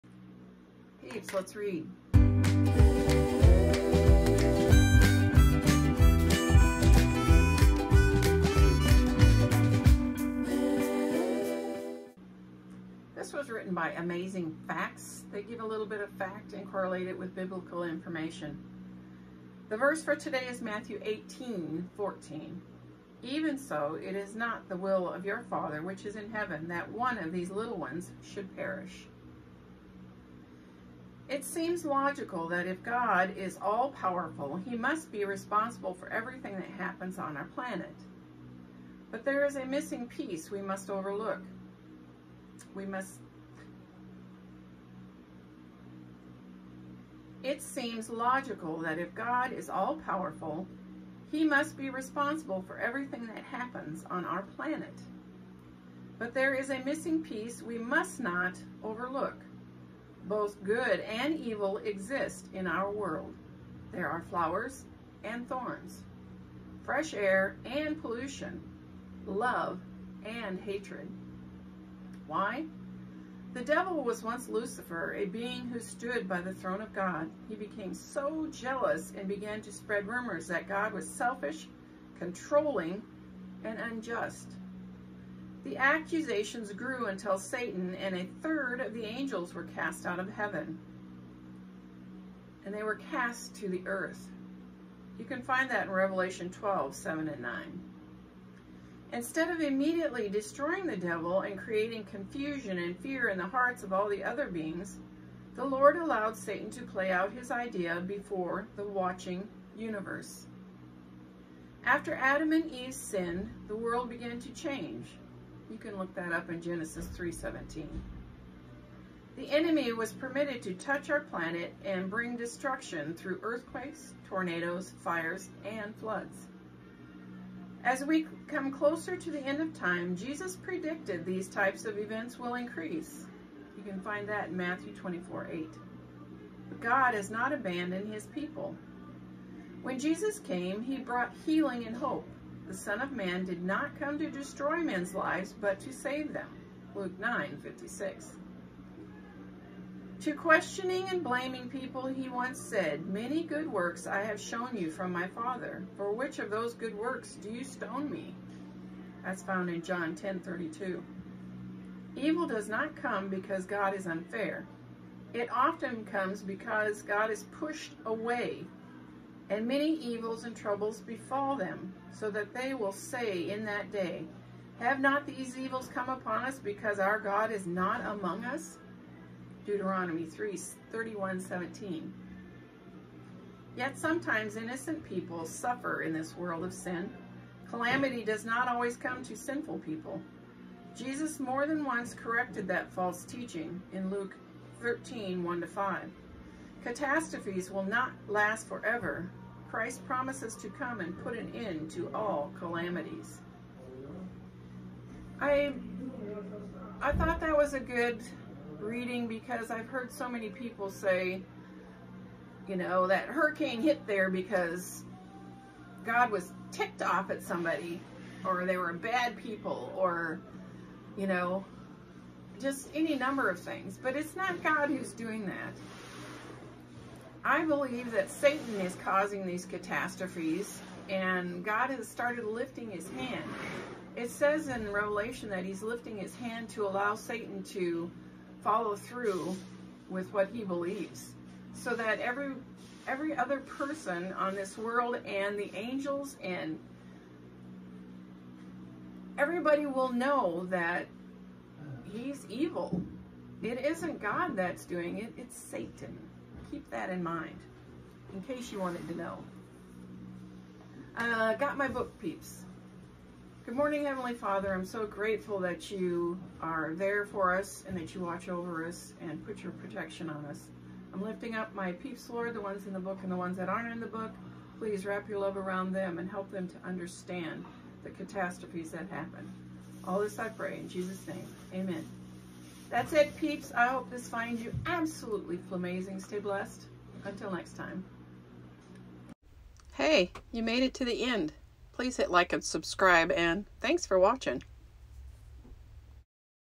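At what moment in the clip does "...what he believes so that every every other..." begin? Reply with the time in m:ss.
4:00.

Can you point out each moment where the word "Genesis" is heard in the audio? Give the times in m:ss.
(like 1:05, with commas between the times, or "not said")
1:56.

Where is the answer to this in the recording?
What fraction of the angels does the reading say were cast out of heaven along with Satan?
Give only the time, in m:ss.
1:28.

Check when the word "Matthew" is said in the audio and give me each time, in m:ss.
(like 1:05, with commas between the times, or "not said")
0:20, 2:14.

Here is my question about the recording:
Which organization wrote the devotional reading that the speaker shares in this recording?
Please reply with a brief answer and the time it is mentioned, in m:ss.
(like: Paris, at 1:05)
Amazing Facts, at 0:13.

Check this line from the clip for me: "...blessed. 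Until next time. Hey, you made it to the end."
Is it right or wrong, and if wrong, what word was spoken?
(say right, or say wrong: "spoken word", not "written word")
right.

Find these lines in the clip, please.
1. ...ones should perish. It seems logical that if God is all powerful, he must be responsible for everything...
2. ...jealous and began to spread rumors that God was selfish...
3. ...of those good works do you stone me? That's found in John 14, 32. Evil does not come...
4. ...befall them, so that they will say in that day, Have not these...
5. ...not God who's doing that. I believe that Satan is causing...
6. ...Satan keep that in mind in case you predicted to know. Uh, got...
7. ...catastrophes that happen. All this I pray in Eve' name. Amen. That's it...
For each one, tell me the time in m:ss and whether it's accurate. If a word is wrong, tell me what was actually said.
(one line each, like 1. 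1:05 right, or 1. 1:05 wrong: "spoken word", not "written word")
1. 0:27 right
2. 1:18 right
3. 2:36 wrong: "10", not "14"
4. 2:51 right
5. 3:44 right
6. 4:15 wrong: "wanted", not "predicted"
7. 4:38 wrong: "Jesus", not "Eve".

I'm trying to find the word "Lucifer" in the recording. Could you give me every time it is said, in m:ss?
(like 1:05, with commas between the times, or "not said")
1:14.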